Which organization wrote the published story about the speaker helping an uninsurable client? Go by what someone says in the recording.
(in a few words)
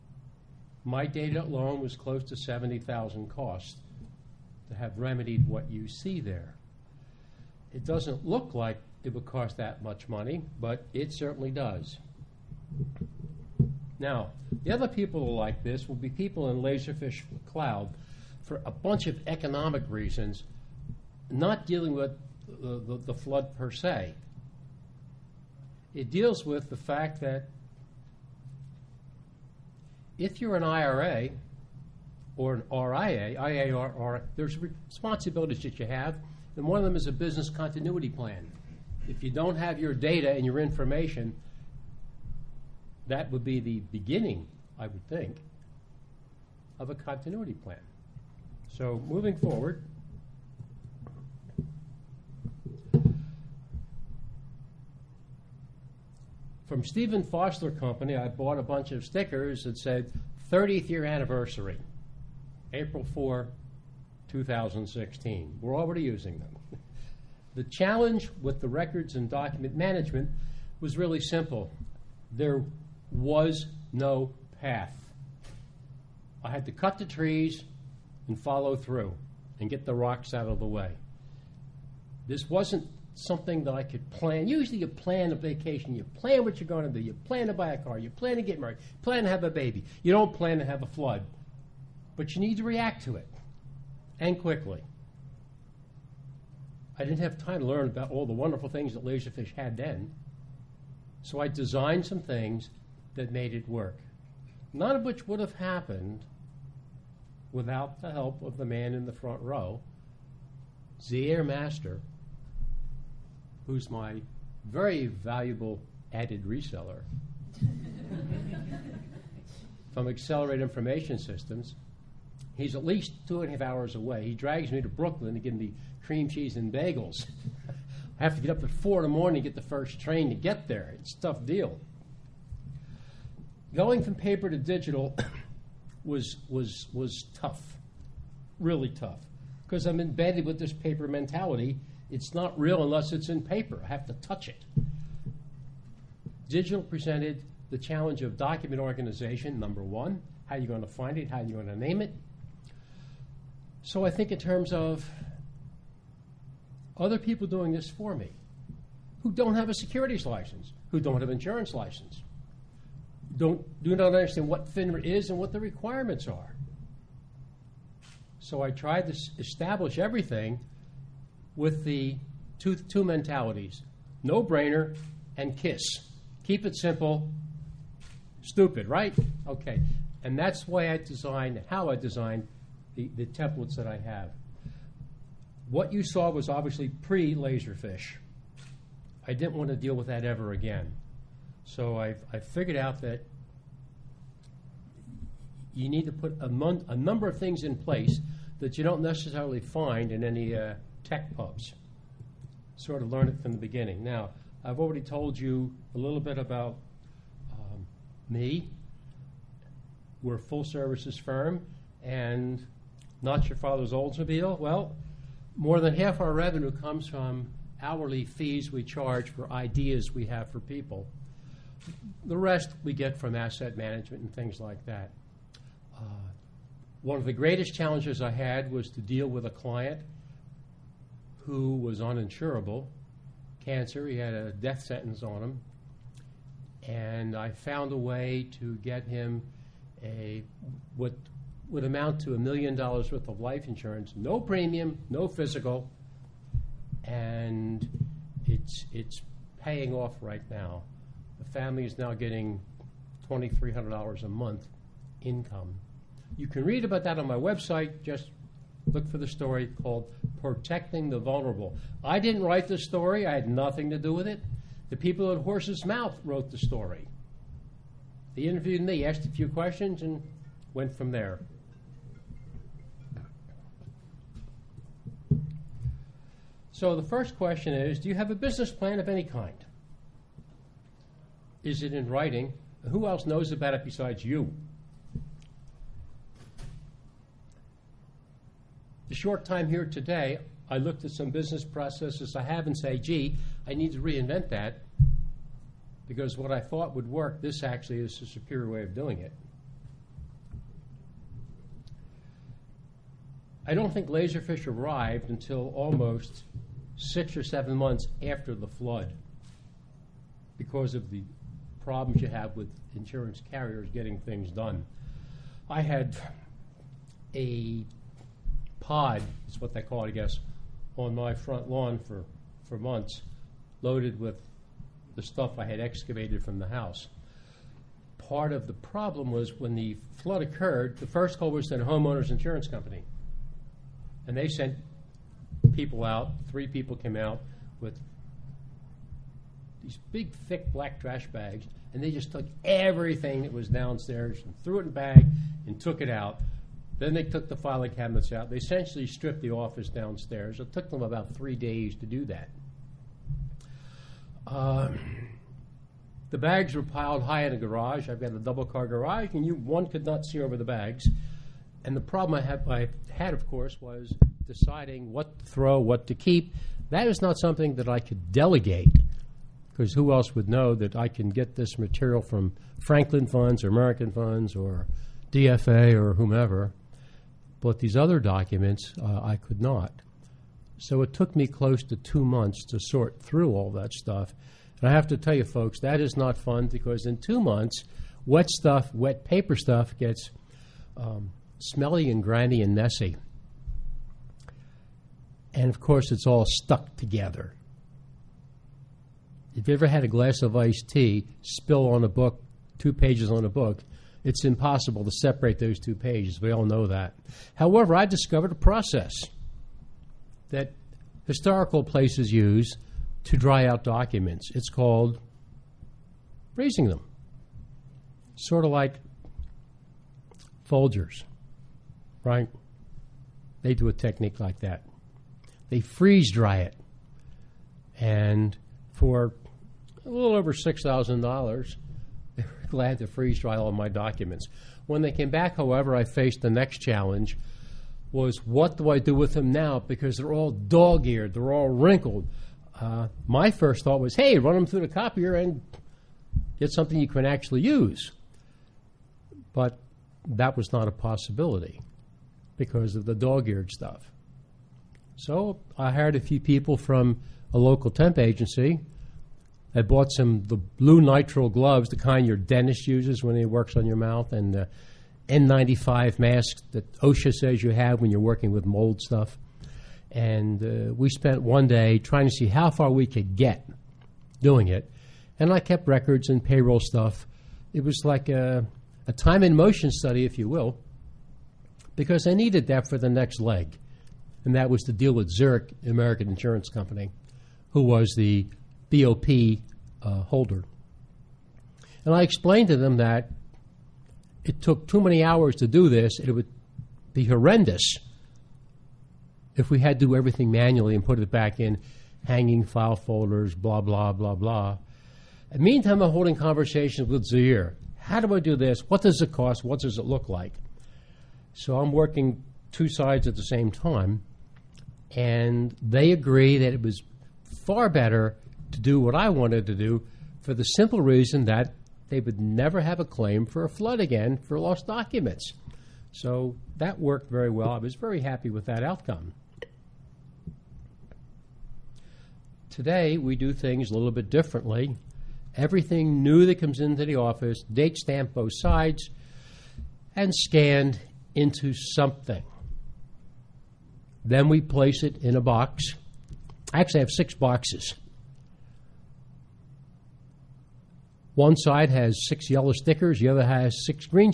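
Horsesmouth.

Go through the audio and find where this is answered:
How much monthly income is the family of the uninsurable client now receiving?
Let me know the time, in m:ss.
4:13.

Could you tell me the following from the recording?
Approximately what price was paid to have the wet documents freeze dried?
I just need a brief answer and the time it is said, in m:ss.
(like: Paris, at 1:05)
$6,000, at 7:10.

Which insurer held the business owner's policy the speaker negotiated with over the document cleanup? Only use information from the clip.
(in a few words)
Zurich American Insurance Company.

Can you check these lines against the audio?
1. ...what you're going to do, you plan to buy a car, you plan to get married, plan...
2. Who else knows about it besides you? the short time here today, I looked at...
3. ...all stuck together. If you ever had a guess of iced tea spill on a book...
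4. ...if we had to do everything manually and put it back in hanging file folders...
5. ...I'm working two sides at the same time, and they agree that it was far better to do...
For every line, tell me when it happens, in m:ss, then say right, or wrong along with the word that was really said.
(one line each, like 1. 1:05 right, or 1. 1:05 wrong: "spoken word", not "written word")
1. 1:26 right
2. 4:42 right
3. 6:36 wrong: "glass", not "guess"
4. 8:19 right
5. 8:31 right.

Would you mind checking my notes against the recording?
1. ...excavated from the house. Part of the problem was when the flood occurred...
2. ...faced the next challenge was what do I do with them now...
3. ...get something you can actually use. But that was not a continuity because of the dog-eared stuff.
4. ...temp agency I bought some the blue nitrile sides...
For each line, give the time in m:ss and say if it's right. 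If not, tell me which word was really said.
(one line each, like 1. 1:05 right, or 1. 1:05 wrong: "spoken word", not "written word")
1. 5:25 right
2. 7:16 right
3. 7:26 wrong: "possibility", not "continuity"
4. 7:37 wrong: "gloves", not "sides".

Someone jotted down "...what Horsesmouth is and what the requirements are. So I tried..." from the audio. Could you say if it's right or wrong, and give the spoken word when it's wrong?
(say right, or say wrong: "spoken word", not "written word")
wrong: "FINRA", not "Horsesmouth".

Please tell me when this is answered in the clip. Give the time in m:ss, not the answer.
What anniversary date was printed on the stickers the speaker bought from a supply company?
1:02.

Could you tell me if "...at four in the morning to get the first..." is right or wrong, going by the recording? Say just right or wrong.
right.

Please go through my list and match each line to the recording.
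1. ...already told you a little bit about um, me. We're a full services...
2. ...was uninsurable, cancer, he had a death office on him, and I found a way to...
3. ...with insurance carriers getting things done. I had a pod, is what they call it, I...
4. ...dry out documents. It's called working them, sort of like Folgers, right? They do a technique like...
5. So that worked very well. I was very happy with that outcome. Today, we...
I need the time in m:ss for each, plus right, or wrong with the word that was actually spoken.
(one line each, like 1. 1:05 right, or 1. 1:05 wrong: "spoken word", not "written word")
1. 3:24 right
2. 3:51 wrong: "sentence", not "office"
3. 5:12 right
4. 6:53 wrong: "raising", not "working"
5. 8:46 right.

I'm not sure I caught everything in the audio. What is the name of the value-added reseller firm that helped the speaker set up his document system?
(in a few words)
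Accelerate Information Systems.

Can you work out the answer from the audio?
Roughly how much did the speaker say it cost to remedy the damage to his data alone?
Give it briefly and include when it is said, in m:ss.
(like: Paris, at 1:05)
70,000, at 0:02.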